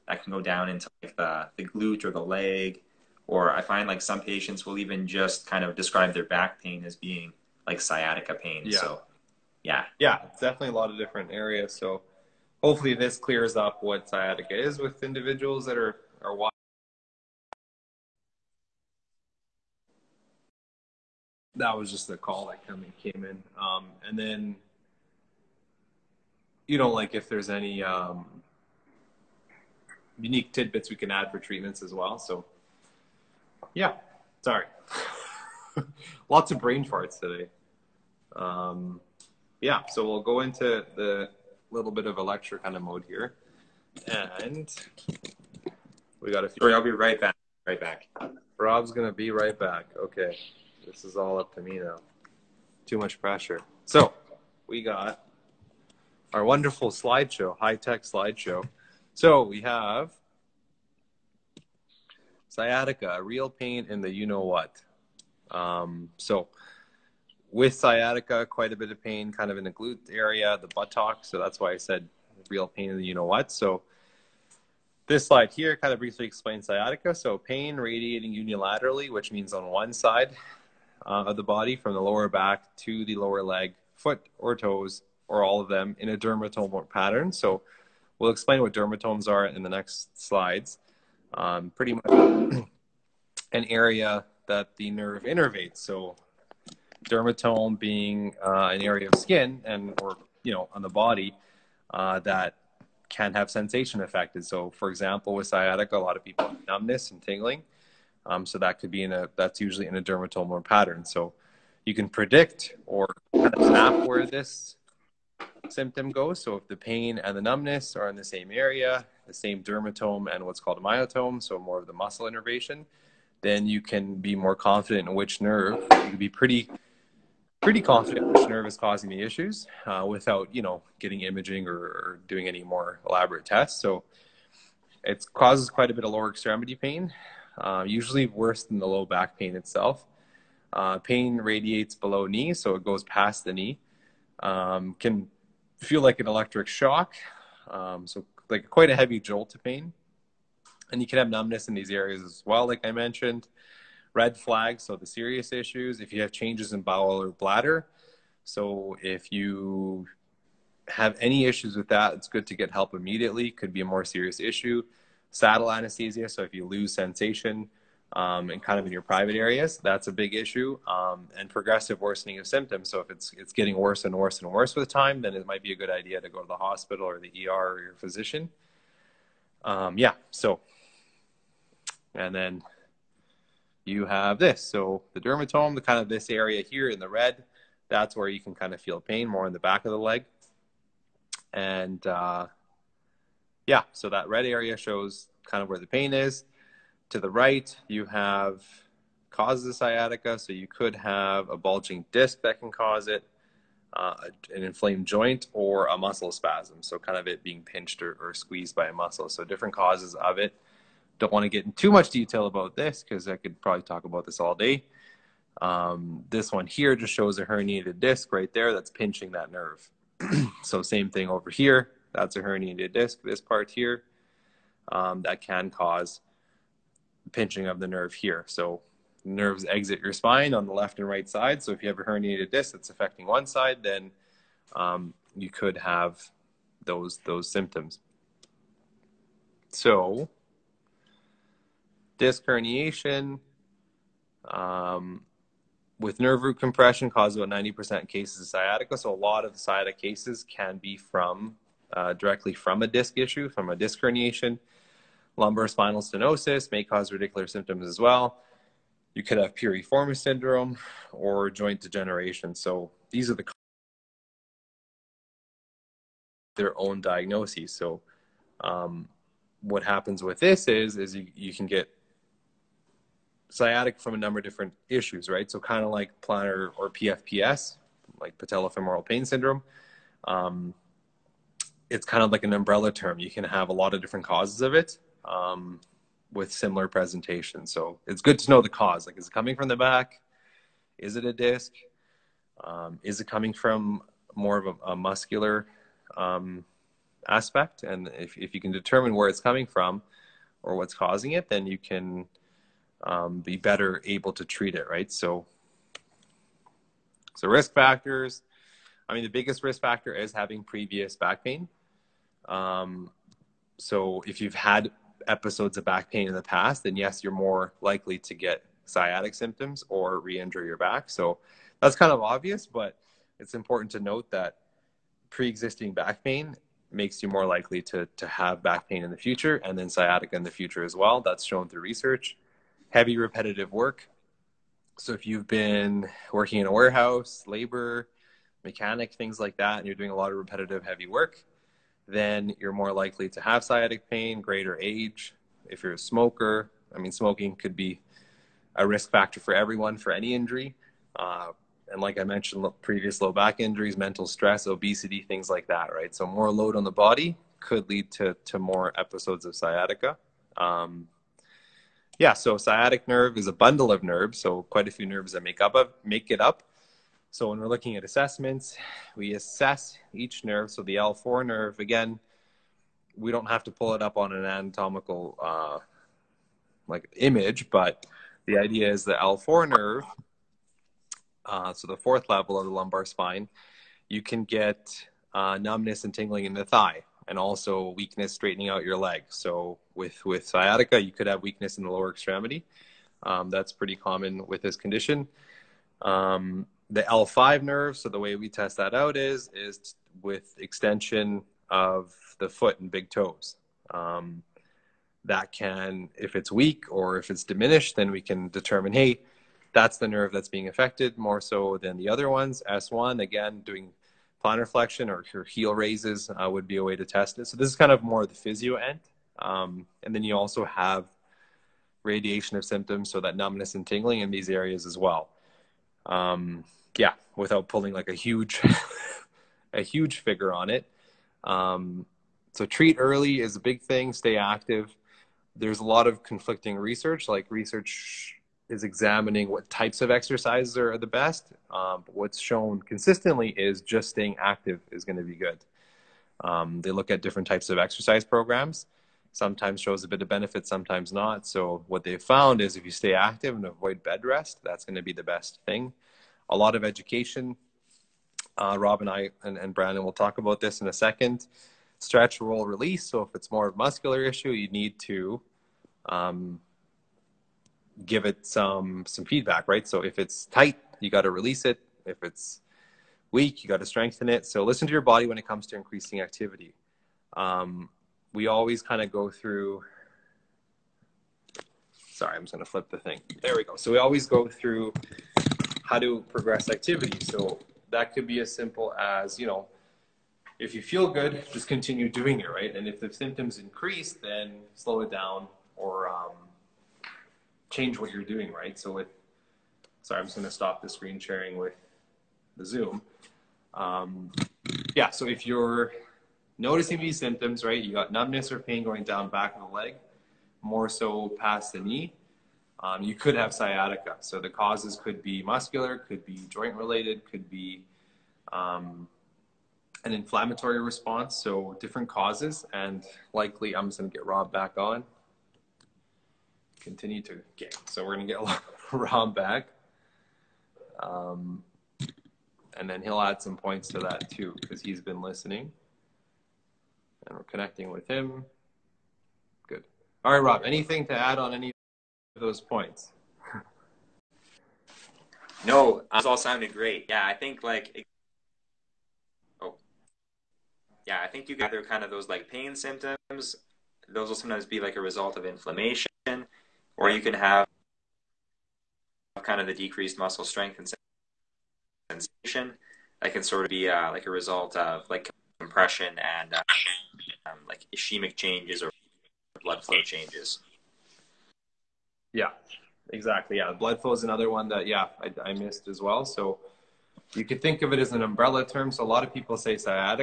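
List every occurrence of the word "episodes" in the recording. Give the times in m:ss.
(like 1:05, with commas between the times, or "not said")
5:15, 5:58.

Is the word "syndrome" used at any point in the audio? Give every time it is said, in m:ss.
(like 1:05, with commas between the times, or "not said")
4:20, 4:39.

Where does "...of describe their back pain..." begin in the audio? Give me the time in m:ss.
0:05.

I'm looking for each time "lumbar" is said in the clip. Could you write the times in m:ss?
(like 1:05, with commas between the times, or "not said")
4:15, 6:22.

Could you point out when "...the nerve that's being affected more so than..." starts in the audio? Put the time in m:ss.
6:49.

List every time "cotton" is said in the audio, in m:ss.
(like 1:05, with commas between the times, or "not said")
not said.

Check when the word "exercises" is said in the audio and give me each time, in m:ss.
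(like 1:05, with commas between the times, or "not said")
7:20, 7:27.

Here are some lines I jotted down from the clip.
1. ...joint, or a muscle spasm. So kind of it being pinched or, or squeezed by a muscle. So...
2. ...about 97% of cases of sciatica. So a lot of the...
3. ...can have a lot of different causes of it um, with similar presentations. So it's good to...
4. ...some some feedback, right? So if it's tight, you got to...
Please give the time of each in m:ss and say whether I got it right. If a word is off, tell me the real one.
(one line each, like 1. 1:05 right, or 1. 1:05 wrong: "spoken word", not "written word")
1. 3:25 right
2. 4:07 wrong: "90", not "97"
3. 4:43 right
4. 7:48 right.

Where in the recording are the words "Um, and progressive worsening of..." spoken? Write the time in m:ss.
2:50.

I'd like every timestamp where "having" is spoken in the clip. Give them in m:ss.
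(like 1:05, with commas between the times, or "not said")
5:10.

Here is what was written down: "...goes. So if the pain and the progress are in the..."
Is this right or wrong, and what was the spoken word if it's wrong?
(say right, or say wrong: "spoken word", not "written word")
wrong: "numbness", not "progress".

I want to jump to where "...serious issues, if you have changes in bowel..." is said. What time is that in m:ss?
2:35.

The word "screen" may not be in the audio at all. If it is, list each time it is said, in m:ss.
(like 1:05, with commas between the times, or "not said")
8:20.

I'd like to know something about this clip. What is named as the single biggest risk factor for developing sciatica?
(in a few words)
Previous back pain.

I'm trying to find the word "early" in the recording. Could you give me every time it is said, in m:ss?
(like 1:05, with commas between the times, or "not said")
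7:12.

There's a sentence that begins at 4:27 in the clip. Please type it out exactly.
So um, what happens with this is is you, you can get sciatic from a number of different issues, right?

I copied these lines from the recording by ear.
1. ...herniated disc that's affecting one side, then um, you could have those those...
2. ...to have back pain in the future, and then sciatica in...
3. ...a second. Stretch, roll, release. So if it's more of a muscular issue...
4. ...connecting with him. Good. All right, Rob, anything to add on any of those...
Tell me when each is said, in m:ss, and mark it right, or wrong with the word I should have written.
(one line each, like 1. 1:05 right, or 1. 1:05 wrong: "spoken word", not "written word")
1. 3:52 right
2. 5:28 right
3. 7:40 right
4. 8:57 right.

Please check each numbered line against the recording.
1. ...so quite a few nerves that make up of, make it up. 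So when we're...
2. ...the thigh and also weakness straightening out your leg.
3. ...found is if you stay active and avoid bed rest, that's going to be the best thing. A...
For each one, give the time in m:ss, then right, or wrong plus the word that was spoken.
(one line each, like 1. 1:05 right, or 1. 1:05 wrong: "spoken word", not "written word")
1. 6:04 right
2. 6:26 right
3. 7:32 right.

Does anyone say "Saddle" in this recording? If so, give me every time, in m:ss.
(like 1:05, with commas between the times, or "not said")
2:45.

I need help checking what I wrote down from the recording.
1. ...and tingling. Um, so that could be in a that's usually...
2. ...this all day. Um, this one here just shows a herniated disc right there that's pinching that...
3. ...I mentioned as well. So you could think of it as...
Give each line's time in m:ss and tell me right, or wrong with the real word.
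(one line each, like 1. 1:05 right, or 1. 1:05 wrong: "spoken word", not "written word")
1. 1:47 right
2. 3:34 right
3. 9:35 wrong: "missed", not "mentioned".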